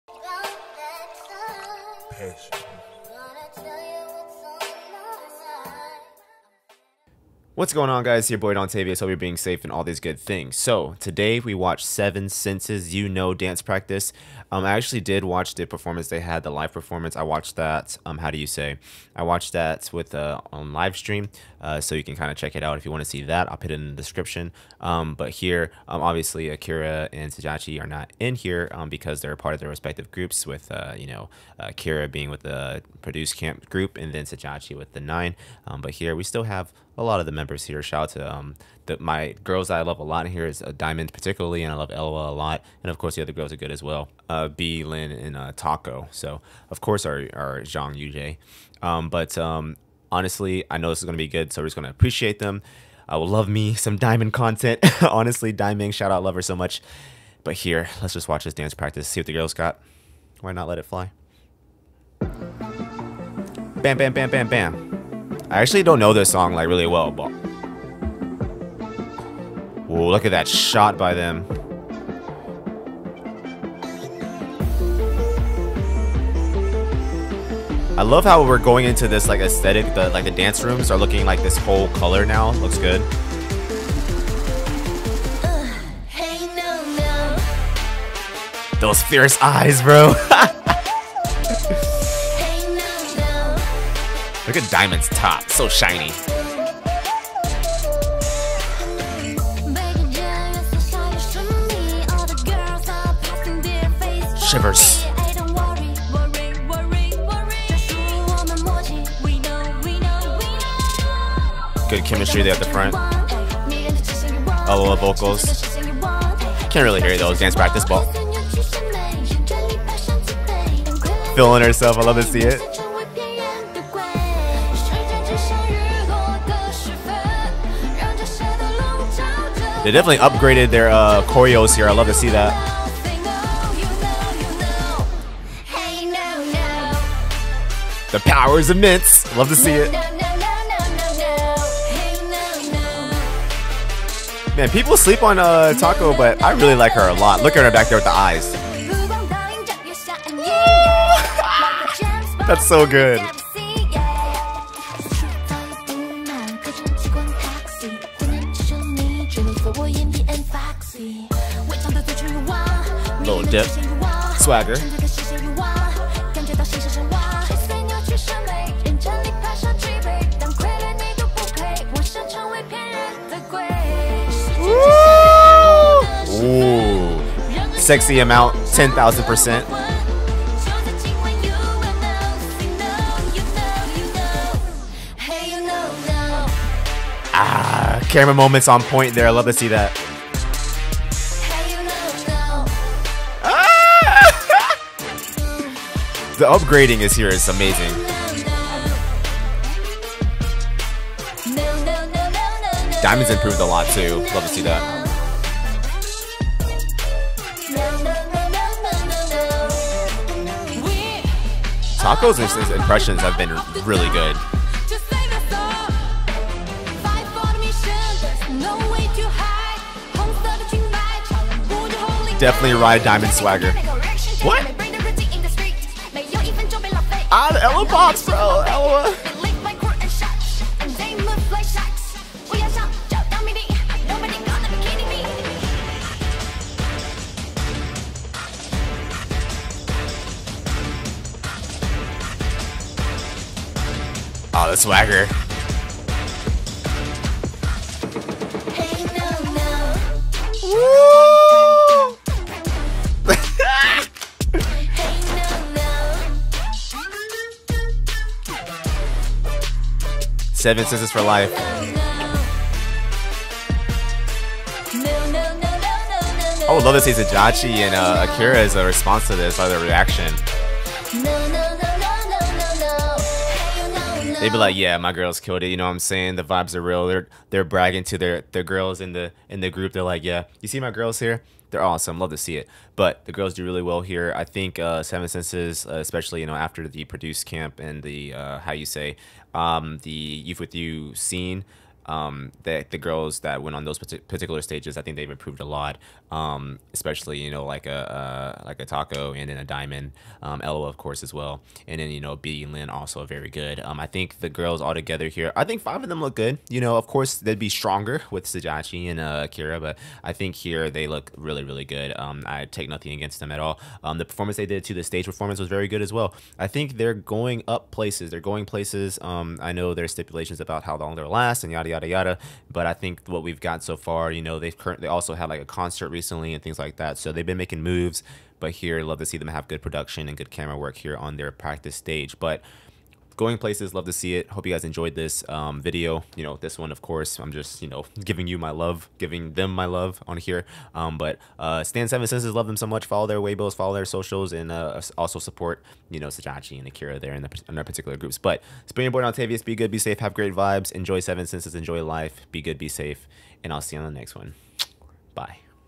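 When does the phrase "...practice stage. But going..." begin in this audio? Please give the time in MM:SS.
05:31.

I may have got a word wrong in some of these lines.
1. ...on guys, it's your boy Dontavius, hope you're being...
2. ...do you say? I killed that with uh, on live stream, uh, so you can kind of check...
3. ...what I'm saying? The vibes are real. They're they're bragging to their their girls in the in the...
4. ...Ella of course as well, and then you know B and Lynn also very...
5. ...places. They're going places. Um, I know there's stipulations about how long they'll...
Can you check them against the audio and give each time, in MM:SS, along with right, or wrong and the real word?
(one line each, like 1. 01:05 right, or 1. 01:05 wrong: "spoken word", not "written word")
1. 00:07 right
2. 00:18 wrong: "watched", not "killed"
3. 04:35 right
4. 05:00 right
5. 05:17 right.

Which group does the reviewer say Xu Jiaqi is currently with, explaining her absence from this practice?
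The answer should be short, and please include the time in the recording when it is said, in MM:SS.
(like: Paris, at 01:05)
The Nine, at 00:34.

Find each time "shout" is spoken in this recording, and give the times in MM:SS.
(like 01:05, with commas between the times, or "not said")
00:37, 00:55.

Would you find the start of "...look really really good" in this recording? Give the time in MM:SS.
05:11.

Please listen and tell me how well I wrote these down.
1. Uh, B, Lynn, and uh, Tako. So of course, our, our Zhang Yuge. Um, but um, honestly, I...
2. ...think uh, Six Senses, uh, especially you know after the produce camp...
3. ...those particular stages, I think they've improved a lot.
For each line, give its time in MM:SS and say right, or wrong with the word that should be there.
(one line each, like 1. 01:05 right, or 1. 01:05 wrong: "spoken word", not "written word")
1. 00:44 right
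2. 04:44 wrong: "Seven", not "Six"
3. 04:53 right.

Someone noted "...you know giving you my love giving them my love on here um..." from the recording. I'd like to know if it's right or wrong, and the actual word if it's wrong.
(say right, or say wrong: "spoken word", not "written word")
right.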